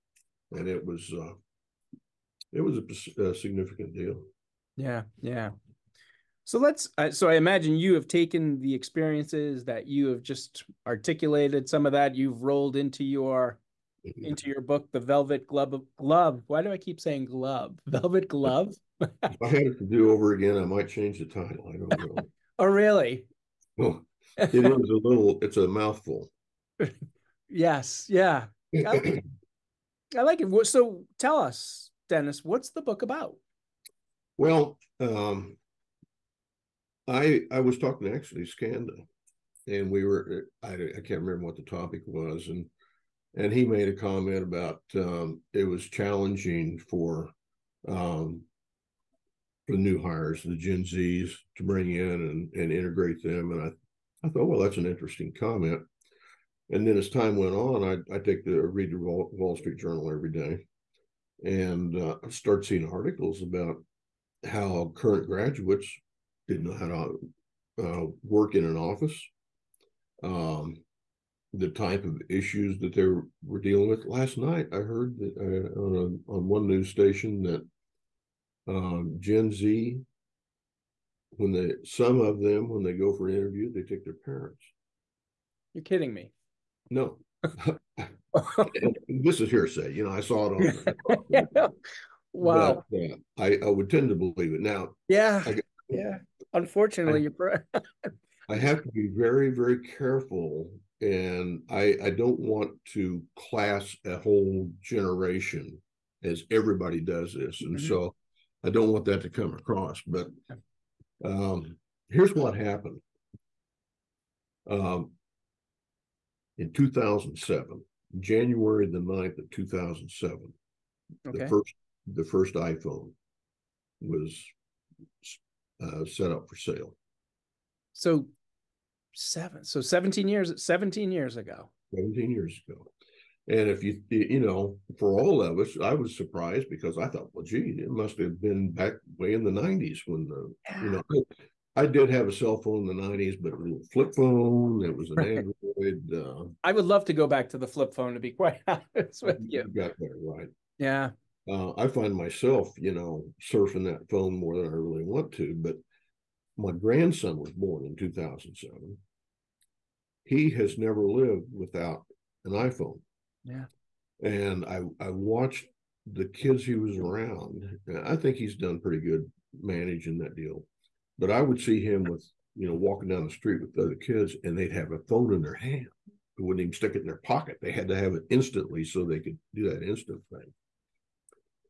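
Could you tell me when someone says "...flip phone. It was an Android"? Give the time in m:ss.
2:23.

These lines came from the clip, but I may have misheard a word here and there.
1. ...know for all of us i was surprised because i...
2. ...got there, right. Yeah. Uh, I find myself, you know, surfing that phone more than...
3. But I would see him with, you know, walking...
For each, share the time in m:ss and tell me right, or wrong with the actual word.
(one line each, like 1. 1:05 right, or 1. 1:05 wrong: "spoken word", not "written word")
1. 2:14 right
2. 2:29 right
3. 2:51 right.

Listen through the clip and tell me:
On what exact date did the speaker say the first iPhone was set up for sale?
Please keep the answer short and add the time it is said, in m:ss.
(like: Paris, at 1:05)
January 9, 2007, at 1:58.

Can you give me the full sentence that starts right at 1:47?
so I don't want that to come across.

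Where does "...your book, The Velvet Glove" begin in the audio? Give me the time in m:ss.
0:14.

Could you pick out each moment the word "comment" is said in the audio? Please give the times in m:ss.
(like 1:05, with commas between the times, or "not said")
0:43, 0:55.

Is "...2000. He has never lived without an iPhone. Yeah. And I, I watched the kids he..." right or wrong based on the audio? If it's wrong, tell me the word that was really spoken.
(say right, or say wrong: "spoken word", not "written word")
wrong: "2007", not "2000".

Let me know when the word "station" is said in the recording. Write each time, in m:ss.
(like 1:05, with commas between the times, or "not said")
1:16.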